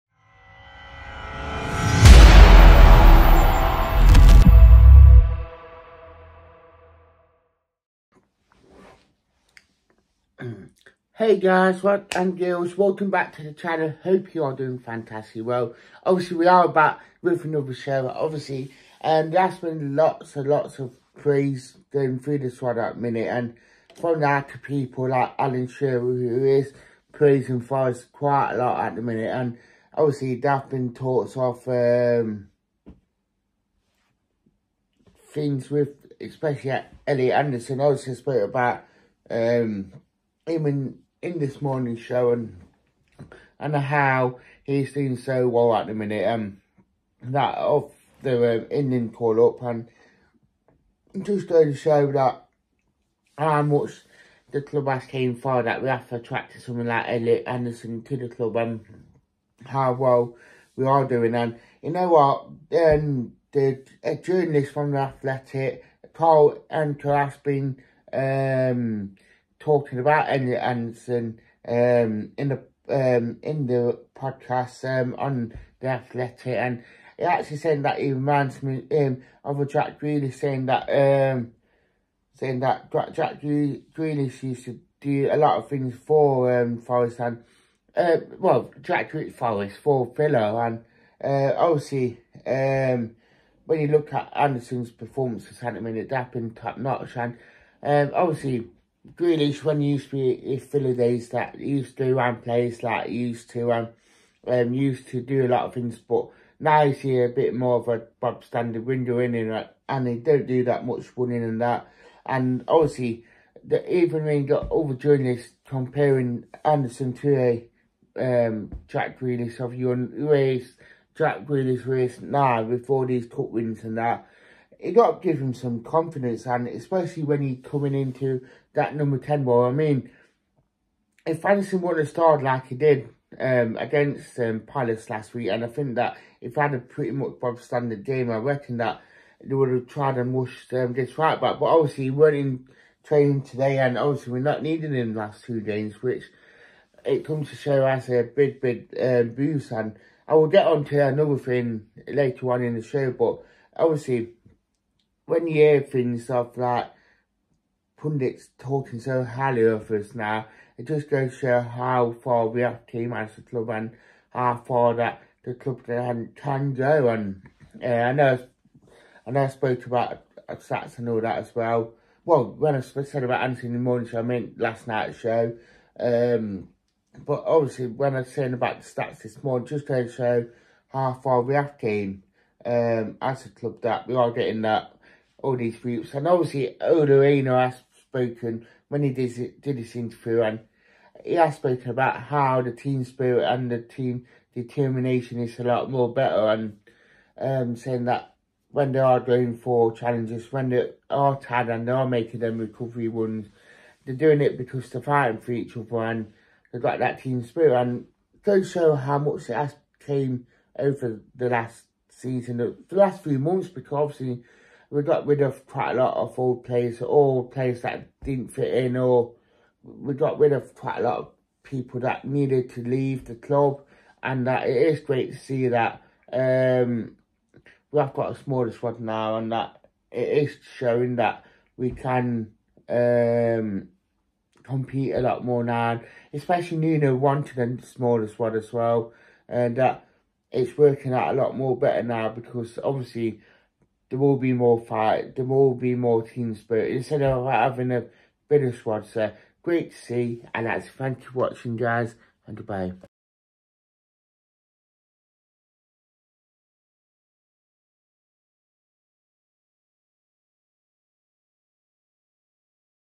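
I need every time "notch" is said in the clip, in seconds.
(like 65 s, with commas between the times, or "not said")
96 s.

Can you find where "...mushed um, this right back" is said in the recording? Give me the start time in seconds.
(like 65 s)
140 s.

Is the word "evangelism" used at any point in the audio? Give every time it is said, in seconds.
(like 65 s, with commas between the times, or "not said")
not said.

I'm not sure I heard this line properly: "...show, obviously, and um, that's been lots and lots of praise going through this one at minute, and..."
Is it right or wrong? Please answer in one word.
right.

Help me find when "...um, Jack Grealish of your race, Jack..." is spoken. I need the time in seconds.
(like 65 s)
118 s.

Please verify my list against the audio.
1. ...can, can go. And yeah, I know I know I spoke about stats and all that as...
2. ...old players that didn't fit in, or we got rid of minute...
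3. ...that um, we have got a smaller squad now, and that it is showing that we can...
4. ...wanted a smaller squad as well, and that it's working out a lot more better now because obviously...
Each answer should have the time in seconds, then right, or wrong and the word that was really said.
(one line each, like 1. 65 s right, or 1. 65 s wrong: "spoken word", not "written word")
1. 165 s right
2. 217 s wrong: "quite", not "minute"
3. 225 s right
4. 237 s right.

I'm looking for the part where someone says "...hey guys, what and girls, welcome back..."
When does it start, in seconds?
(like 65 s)
11 s.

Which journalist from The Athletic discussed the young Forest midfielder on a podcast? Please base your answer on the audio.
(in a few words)
Carl Anka.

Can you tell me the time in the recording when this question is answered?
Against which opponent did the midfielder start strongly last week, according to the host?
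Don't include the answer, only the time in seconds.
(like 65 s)
134 s.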